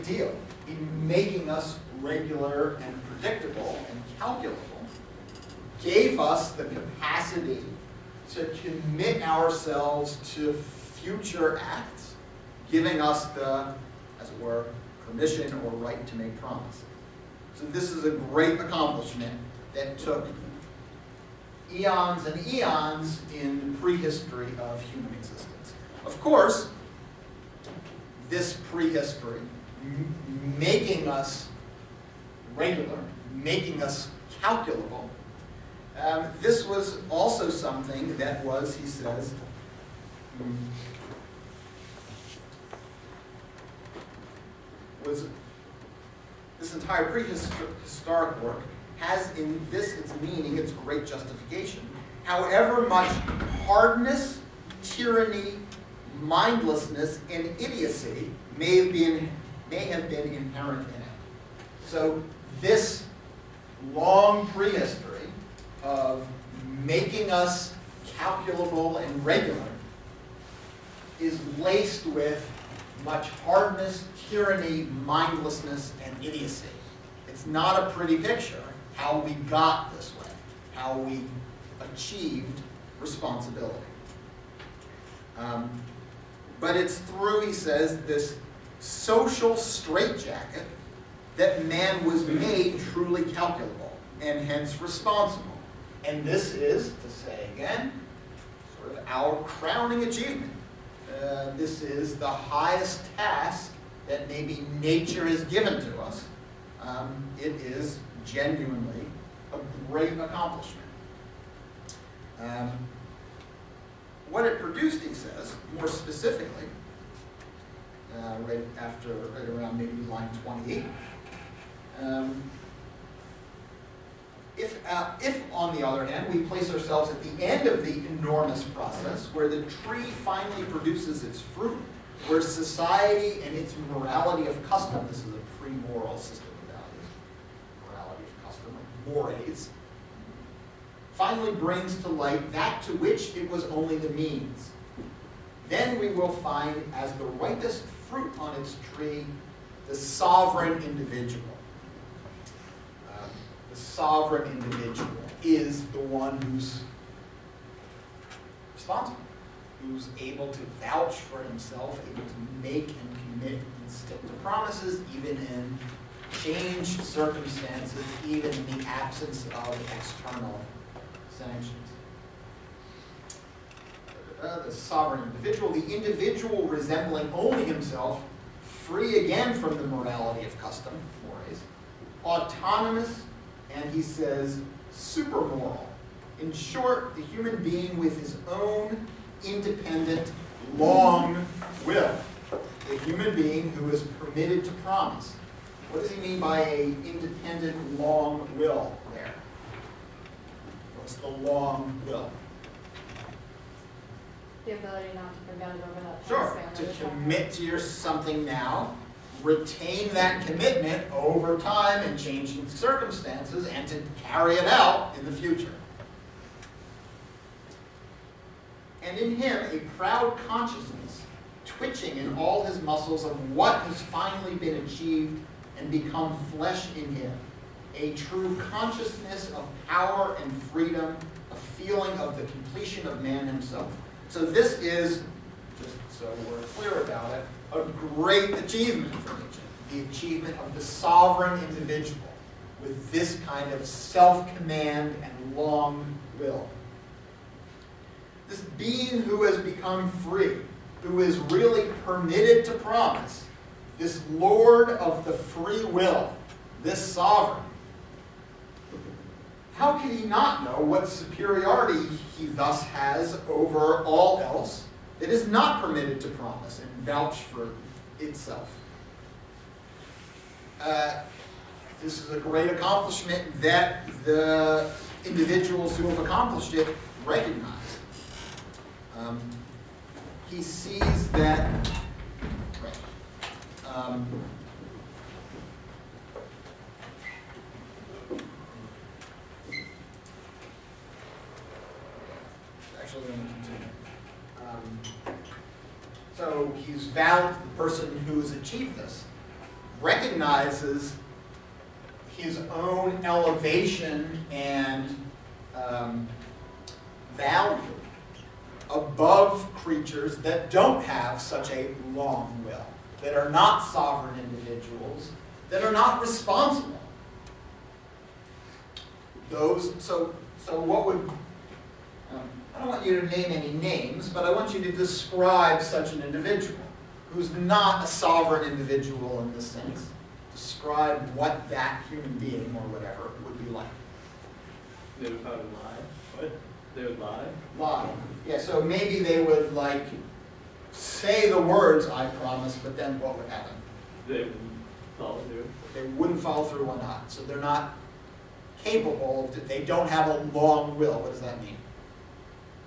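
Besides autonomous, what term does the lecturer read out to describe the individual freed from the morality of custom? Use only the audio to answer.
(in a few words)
supermoral.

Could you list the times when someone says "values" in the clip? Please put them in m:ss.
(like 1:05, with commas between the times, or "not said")
2:17, 5:07.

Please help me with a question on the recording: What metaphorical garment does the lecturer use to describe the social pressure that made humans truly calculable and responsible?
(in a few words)
social straitjacket.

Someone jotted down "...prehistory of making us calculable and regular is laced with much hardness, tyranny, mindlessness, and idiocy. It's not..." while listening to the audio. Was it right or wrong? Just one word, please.
right.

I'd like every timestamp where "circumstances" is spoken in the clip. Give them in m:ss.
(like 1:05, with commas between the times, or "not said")
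2:47, 3:32.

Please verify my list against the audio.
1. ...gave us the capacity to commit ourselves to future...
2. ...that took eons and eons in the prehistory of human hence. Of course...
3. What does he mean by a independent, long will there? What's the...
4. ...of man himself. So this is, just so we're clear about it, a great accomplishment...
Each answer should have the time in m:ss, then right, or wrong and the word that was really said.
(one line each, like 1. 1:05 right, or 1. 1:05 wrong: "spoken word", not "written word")
1. 0:05 right
2. 0:19 wrong: "existence", not "hence"
3. 3:15 right
4. 3:53 wrong: "achievement", not "accomplishment".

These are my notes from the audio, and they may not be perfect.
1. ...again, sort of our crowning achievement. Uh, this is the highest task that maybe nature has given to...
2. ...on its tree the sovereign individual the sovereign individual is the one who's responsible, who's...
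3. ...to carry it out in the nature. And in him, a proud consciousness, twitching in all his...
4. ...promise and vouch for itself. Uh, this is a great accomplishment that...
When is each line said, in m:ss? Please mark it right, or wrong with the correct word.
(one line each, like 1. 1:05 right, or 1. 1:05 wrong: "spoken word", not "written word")
1. 1:37 right
2. 2:28 right
3. 3:33 wrong: "future", not "nature"
4. 4:26 right.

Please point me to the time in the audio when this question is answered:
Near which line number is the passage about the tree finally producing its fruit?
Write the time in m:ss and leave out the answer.
2:00.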